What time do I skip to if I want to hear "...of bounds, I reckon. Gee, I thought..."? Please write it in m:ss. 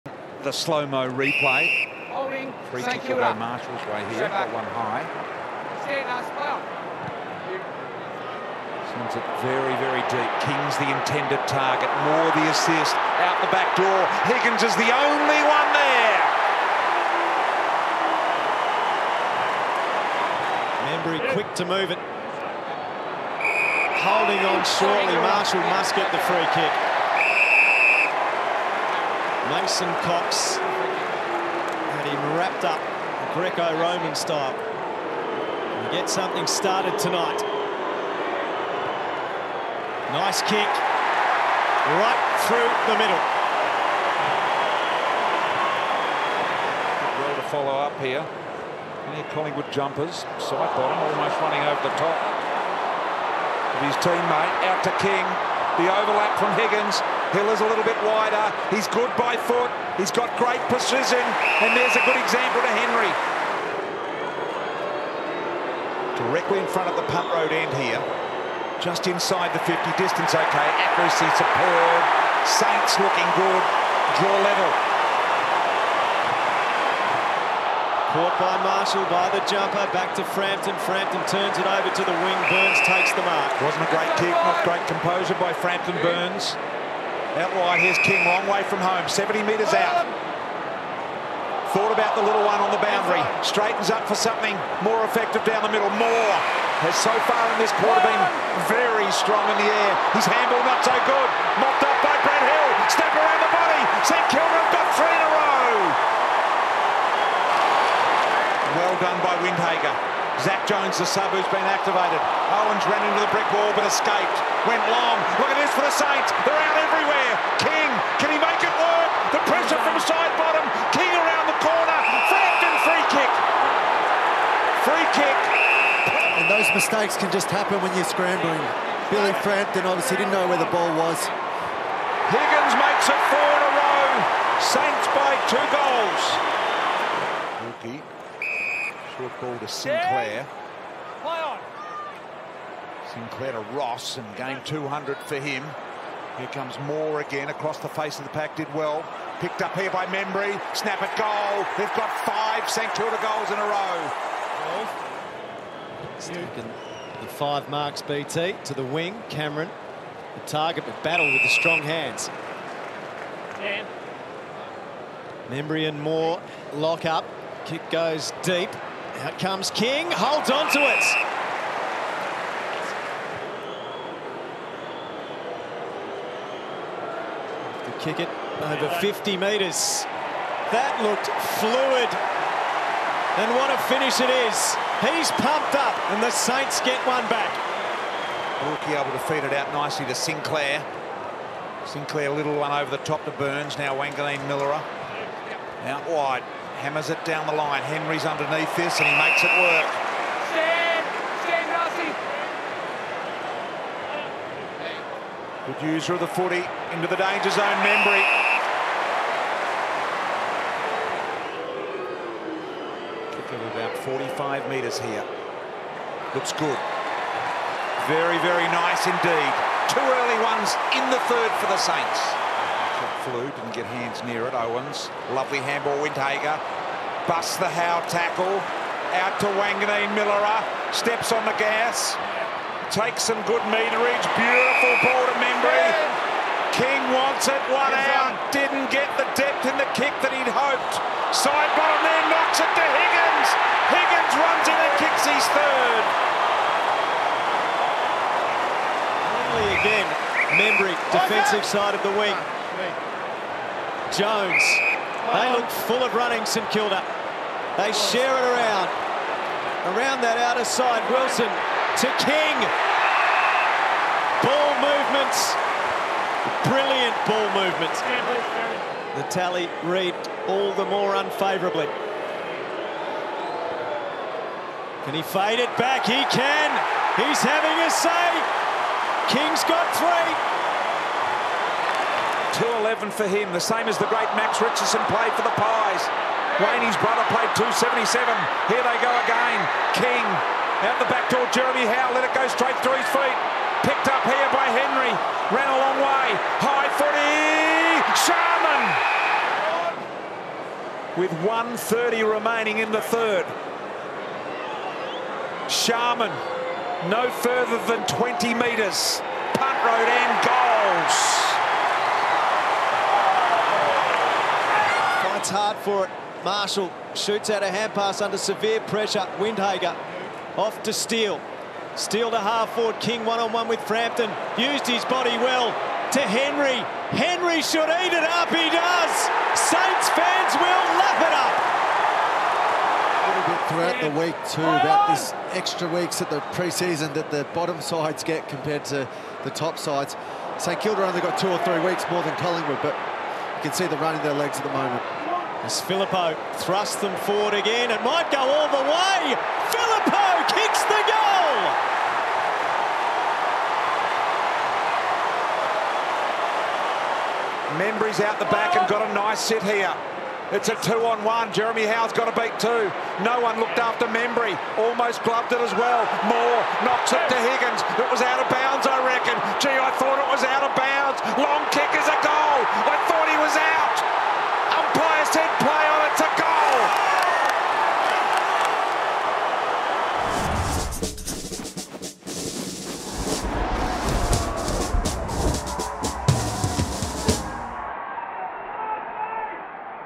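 6:08.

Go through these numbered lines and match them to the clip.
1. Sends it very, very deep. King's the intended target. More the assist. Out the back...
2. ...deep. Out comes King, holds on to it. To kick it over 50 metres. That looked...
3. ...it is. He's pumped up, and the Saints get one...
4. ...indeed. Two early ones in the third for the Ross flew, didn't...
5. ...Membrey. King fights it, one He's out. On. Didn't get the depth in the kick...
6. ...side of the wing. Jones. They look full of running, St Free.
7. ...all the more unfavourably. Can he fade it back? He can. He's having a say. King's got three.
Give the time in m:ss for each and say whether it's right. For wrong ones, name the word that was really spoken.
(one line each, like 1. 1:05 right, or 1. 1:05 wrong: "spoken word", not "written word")
1. 0:08 right
2. 2:48 right
3. 3:04 right
4. 3:39 wrong: "Saints", not "Ross"
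5. 3:55 wrong: "wants", not "fights"
6. 4:11 wrong: "Kilda", not "Free"
7. 4:30 right.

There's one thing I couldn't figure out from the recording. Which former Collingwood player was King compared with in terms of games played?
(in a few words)
Max Richardson.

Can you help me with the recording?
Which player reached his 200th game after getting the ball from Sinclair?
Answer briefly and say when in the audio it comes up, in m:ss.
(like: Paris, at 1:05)
Ross, at 2:23.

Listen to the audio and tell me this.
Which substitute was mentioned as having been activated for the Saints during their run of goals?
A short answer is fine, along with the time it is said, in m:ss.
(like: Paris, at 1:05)
Zak Jones, at 1:50.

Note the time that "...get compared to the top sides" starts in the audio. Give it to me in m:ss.
5:38.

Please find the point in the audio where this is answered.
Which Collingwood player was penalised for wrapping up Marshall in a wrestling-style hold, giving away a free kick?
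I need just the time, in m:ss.
0:29.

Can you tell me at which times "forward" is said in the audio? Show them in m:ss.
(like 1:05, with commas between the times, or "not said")
5:22, 5:47.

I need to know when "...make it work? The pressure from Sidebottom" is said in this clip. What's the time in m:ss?
1:58.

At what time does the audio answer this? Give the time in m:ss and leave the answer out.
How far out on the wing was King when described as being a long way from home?
1:29.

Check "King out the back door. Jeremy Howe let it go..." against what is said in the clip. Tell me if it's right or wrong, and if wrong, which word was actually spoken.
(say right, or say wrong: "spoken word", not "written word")
right.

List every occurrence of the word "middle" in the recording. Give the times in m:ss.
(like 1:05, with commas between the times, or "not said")
0:42, 1:35.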